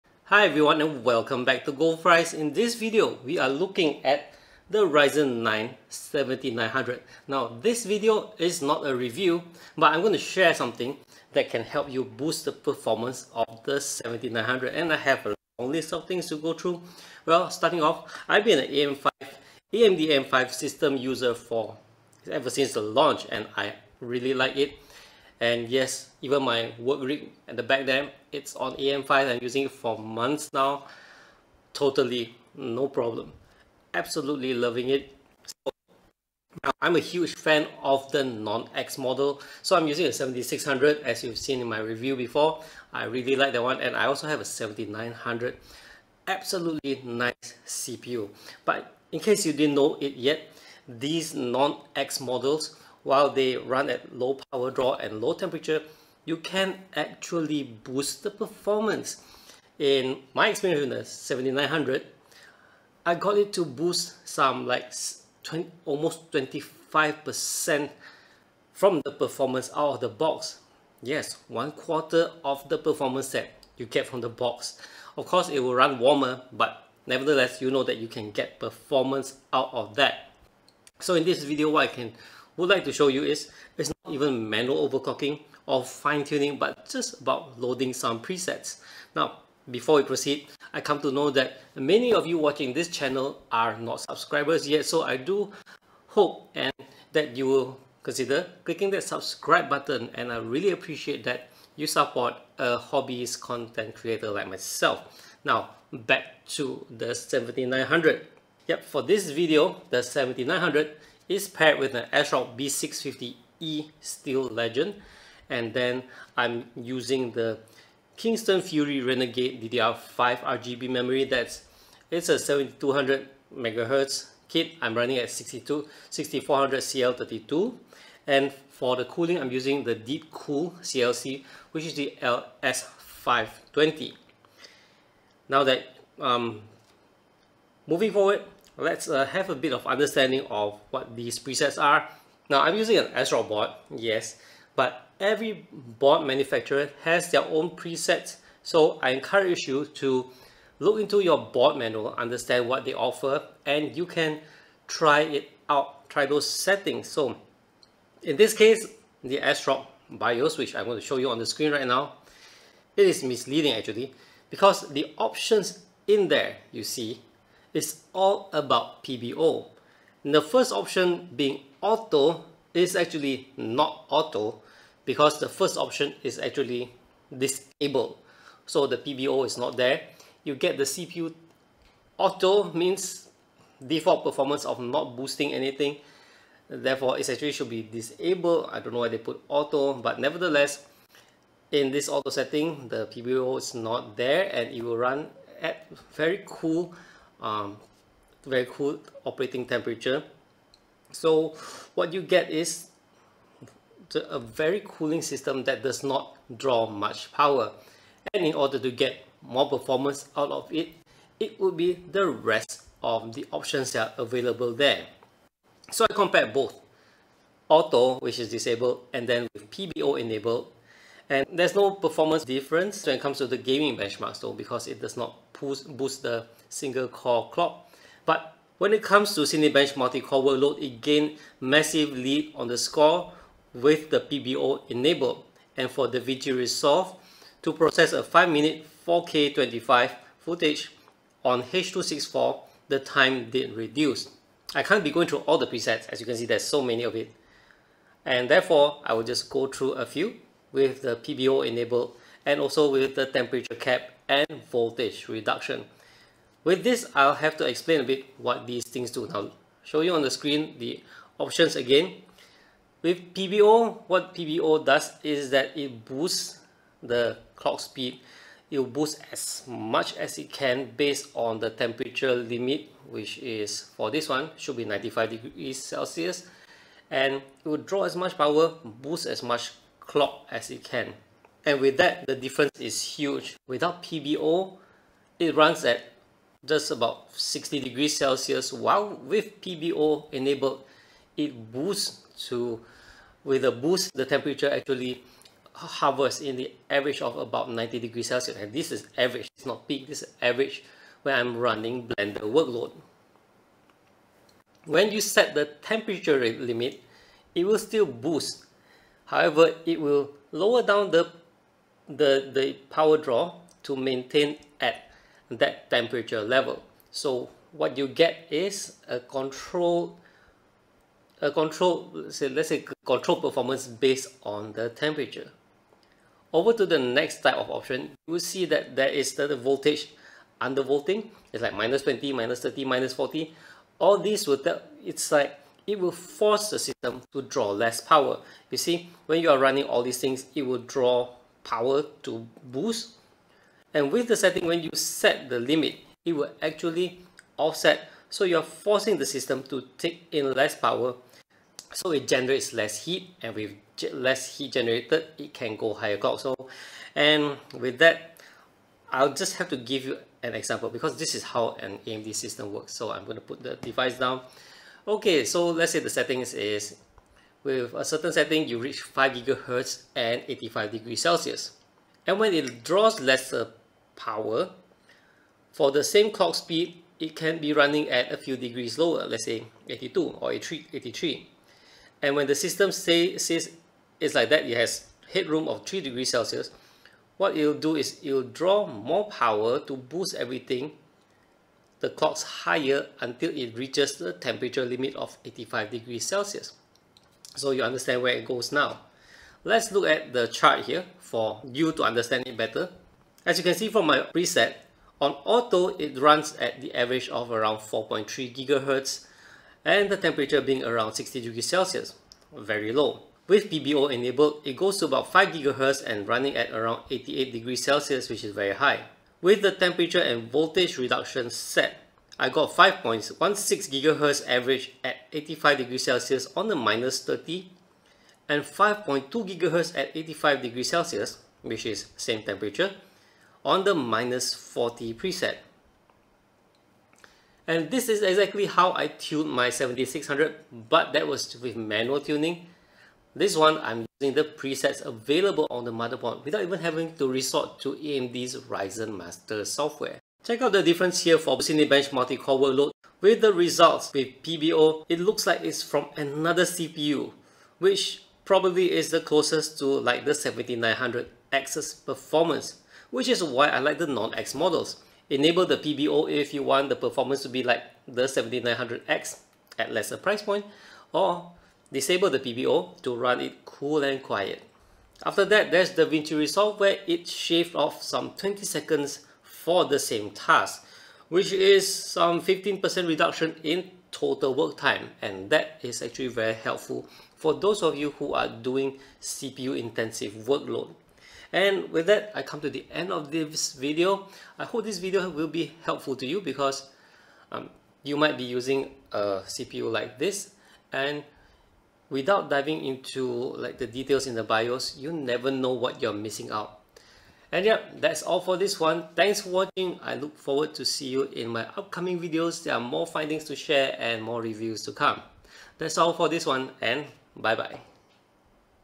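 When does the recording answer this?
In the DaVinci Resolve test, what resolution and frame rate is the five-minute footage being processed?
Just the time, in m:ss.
3:59.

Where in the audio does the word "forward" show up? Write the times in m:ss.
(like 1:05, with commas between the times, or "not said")
2:18, 8:30.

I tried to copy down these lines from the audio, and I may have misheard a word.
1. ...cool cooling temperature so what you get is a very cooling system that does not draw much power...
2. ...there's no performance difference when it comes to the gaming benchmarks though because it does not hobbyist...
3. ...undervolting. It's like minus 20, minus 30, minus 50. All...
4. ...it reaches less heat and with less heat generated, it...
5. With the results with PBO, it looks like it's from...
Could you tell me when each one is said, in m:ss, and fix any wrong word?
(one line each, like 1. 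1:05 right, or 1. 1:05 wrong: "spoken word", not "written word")
1. 3:18 wrong: "operating", not "cooling"
2. 3:41 wrong: "boost", not "hobbyist"
3. 5:30 wrong: "40", not "50"
4. 5:52 wrong: "generates", not "reaches"
5. 7:33 right.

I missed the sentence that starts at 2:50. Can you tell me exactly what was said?
And the first option being auto is actually not auto because the first option is actually disabled.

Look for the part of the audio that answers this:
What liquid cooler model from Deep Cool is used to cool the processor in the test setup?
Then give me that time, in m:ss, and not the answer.
2:12.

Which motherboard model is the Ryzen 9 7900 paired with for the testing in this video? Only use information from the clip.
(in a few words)
ASRock B650E Steel Legend.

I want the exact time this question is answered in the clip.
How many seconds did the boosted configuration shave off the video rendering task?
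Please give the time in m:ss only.
7:58.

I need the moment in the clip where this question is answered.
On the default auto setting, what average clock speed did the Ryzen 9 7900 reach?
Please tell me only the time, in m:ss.
6:47.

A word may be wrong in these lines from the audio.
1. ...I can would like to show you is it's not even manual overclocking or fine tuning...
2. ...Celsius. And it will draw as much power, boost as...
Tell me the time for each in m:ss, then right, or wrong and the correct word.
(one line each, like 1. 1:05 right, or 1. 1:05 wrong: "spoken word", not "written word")
1. 1:21 right
2. 4:35 right.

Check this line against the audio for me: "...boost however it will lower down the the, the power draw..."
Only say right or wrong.
right.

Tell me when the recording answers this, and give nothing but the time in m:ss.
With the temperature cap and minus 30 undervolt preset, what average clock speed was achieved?
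7:02.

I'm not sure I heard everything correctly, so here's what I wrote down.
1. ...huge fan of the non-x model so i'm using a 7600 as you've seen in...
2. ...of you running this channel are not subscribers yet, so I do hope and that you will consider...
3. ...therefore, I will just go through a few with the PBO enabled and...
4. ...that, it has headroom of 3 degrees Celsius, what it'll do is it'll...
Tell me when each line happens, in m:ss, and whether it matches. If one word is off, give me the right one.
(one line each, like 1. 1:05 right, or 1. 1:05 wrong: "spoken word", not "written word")
1. 0:36 right
2. 1:32 wrong: "watching", not "running"
3. 4:08 right
4. 6:24 right.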